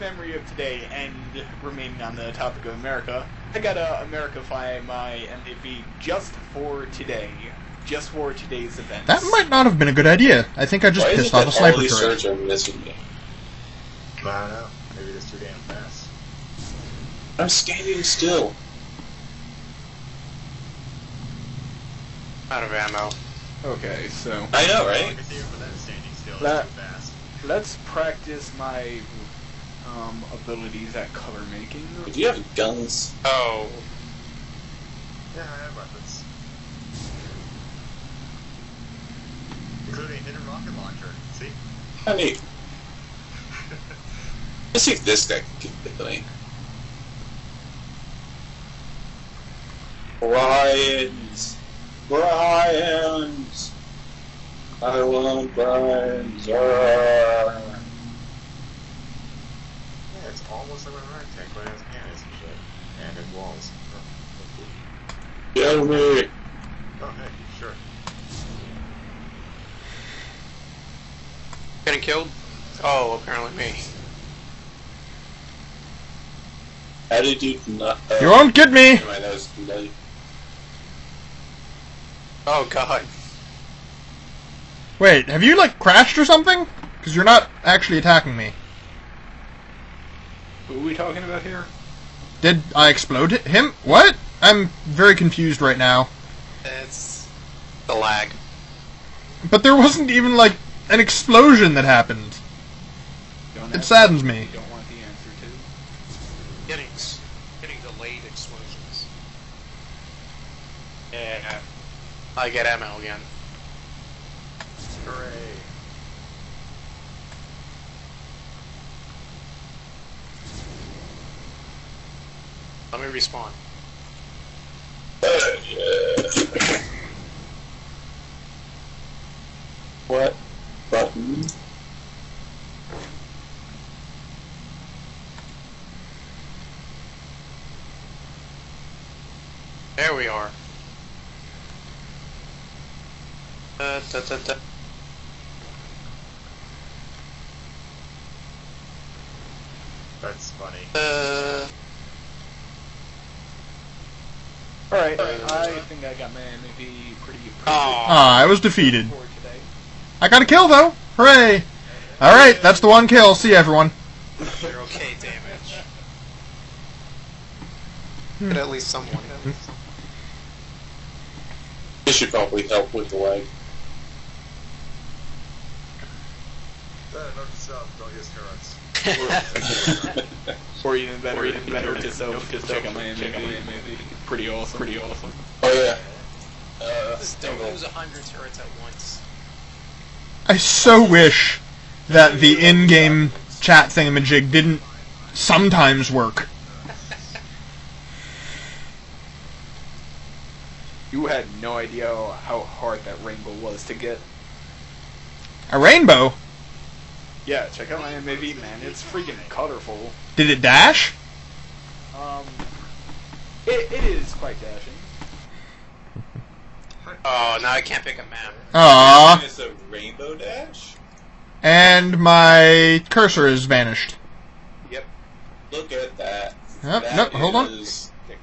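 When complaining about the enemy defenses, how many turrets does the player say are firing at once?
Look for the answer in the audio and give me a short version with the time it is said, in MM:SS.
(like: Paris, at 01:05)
100, at 03:07.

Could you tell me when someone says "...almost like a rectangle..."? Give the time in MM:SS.
01:00.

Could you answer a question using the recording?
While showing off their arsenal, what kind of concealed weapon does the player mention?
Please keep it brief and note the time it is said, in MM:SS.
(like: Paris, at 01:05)
Rocket launcher, at 00:40.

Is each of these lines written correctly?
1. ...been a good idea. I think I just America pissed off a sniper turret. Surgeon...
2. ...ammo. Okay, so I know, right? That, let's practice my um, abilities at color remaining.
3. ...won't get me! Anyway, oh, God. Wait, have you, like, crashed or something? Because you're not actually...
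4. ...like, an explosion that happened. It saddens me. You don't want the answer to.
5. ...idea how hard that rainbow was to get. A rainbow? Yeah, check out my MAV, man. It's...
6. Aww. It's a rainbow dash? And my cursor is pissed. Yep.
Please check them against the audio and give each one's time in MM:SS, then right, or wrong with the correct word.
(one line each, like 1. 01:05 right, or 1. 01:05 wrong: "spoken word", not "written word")
1. 00:09 wrong: "Why", not "America"
2. 00:22 wrong: "making", not "remaining"
3. 01:18 right
4. 01:40 right
5. 03:21 right
6. 03:38 wrong: "vanished", not "pissed".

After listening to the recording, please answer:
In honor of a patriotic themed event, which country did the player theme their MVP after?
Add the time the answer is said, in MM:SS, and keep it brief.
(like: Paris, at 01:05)
America, at 00:02.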